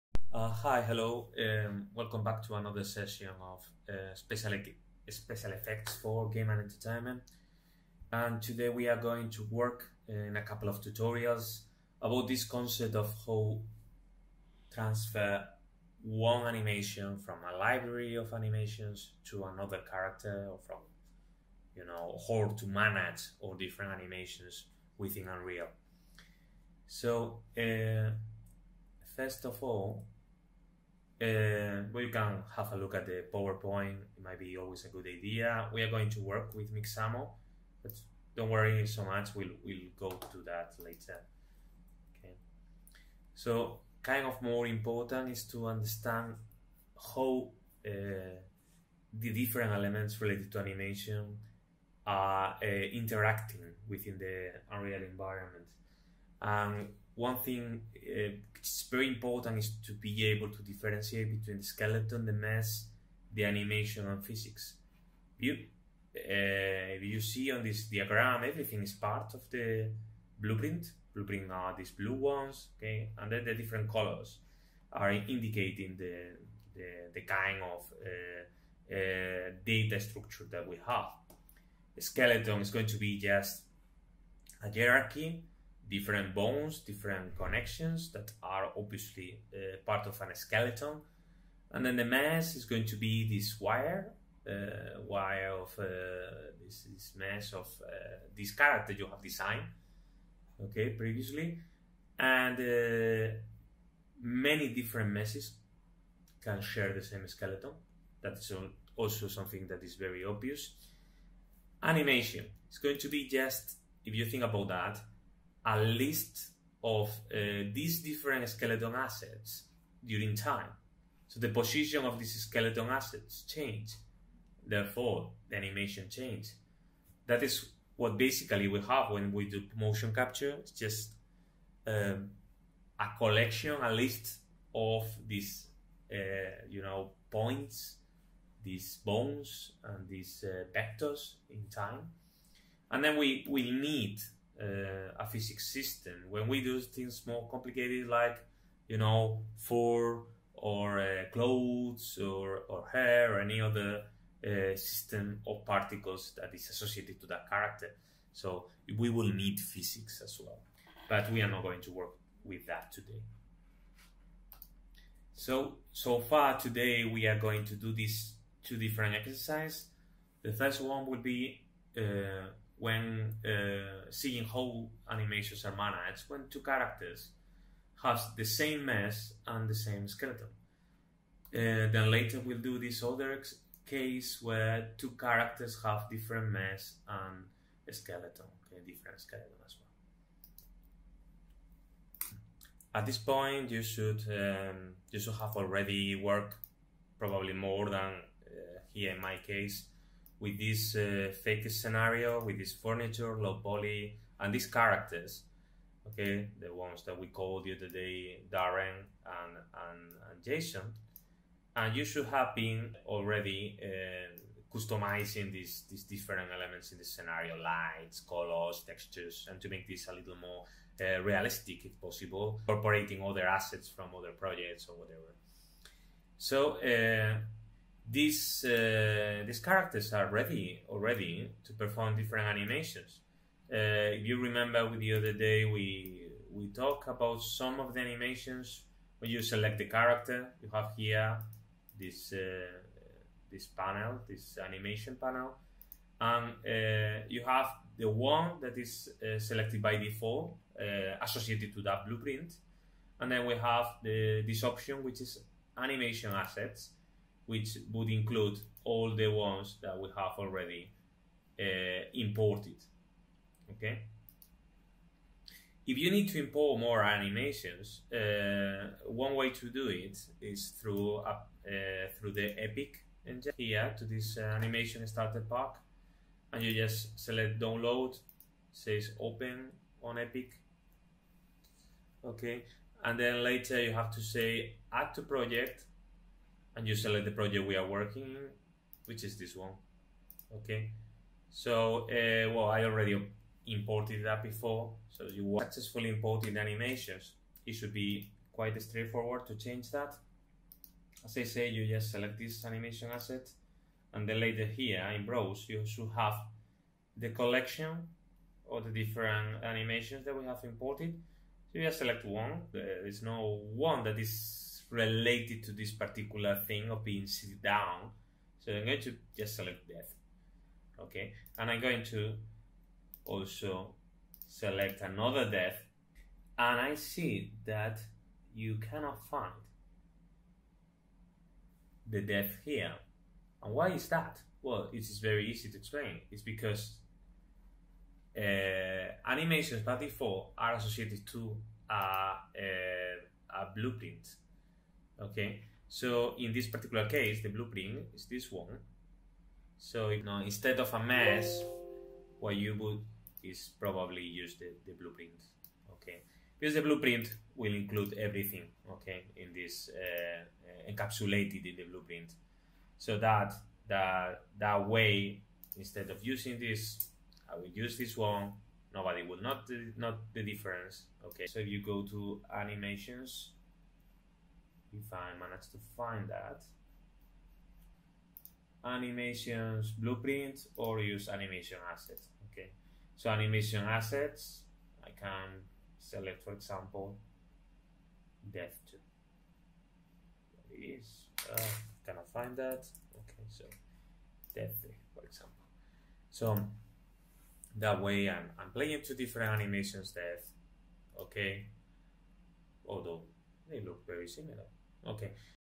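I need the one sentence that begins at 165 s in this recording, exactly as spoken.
So, so far today we are going to do these two different exercises.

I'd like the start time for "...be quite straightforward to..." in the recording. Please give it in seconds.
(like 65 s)
297 s.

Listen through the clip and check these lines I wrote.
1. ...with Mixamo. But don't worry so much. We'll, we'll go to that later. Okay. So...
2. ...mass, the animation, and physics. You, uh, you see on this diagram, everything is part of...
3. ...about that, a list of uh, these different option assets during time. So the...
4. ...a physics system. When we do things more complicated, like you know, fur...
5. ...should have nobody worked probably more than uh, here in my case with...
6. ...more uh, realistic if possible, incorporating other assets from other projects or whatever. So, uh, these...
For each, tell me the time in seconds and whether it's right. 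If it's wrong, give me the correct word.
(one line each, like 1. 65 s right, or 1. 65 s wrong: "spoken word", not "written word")
1. 36 s right
2. 62 s right
3. 114 s wrong: "skeleton", not "option"
4. 145 s right
5. 195 s wrong: "already", not "nobody"
6. 220 s right.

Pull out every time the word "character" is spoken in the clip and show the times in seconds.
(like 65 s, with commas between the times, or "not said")
19 s, 98 s, 157 s, 176 s, 185 s, 204 s, 229 s, 239 s.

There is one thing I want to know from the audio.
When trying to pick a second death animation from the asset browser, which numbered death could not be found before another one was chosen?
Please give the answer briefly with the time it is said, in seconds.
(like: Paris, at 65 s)
Death 2, at 388 s.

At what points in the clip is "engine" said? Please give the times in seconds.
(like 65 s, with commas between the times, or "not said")
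273 s.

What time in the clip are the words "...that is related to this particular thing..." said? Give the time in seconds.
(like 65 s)
314 s.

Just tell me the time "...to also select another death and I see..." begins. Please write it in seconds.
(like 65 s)
322 s.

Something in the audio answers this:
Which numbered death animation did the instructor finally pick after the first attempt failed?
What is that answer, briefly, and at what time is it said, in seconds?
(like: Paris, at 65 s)
Death 3, at 394 s.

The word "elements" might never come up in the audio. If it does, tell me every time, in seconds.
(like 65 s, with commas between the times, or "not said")
49 s, 216 s.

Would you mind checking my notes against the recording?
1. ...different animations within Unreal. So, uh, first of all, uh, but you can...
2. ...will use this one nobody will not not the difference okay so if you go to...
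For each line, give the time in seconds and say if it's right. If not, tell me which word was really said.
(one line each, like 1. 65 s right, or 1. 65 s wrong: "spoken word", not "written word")
1. 23 s right
2. 367 s right.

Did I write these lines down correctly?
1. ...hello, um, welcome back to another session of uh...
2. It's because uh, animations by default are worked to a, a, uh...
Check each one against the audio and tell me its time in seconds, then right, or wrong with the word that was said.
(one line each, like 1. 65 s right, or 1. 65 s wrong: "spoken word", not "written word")
1. 0 s right
2. 336 s wrong: "associated", not "worked".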